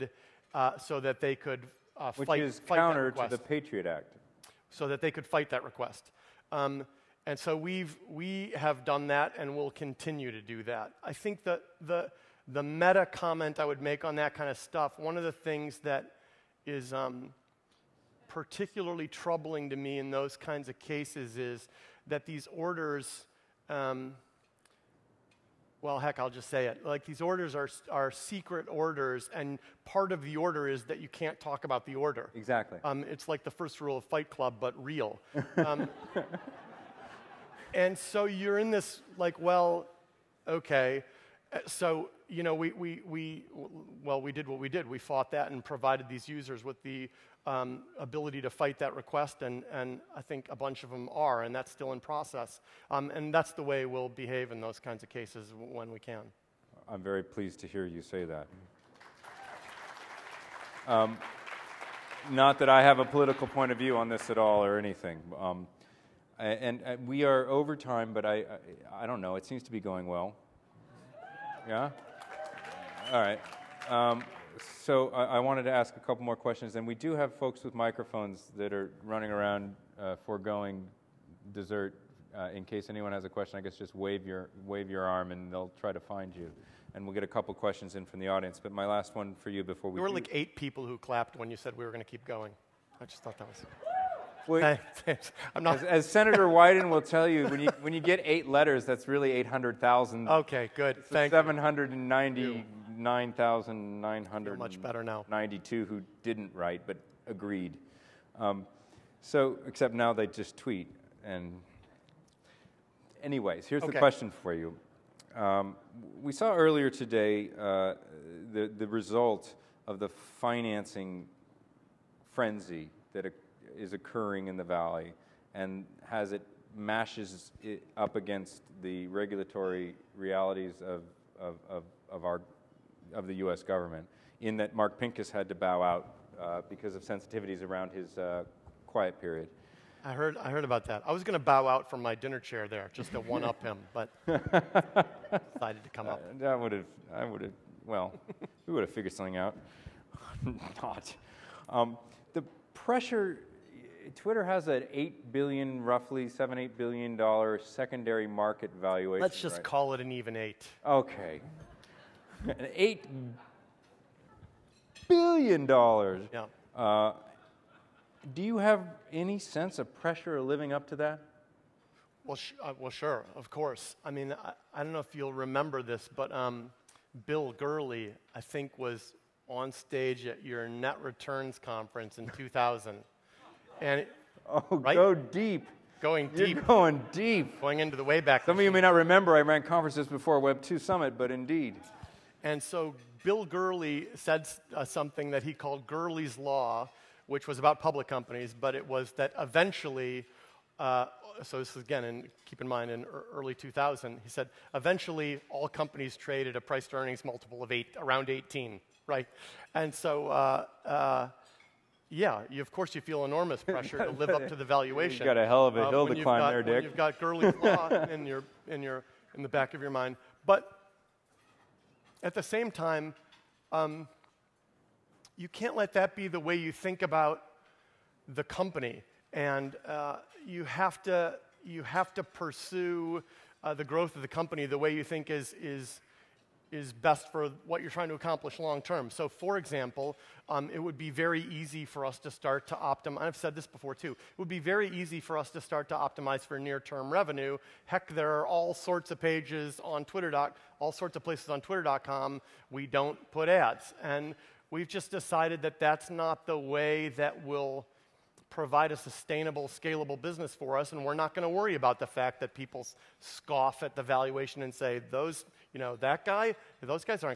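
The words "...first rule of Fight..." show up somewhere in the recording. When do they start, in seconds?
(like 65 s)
33 s.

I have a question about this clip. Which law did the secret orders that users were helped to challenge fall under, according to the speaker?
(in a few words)
Patriot Act.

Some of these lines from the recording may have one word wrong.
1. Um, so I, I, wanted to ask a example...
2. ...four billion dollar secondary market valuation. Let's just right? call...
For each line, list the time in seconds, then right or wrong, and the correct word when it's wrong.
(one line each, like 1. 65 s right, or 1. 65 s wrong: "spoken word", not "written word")
1. 73 s wrong: "couple", not "example"
2. 156 s wrong: "eight", not "four".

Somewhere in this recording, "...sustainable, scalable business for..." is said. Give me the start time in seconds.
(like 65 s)
258 s.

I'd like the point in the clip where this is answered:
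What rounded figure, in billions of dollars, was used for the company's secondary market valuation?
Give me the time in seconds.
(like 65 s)
162 s.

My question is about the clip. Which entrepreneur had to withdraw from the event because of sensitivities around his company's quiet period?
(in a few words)
Mark Pincus.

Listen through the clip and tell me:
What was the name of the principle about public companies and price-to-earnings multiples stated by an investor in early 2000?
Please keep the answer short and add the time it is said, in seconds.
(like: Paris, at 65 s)
Gurley's Law, at 195 s.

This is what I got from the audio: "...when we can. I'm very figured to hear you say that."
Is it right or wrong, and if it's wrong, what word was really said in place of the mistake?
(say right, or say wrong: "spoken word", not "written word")
wrong: "pleased", not "figured".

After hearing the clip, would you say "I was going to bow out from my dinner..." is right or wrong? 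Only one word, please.
right.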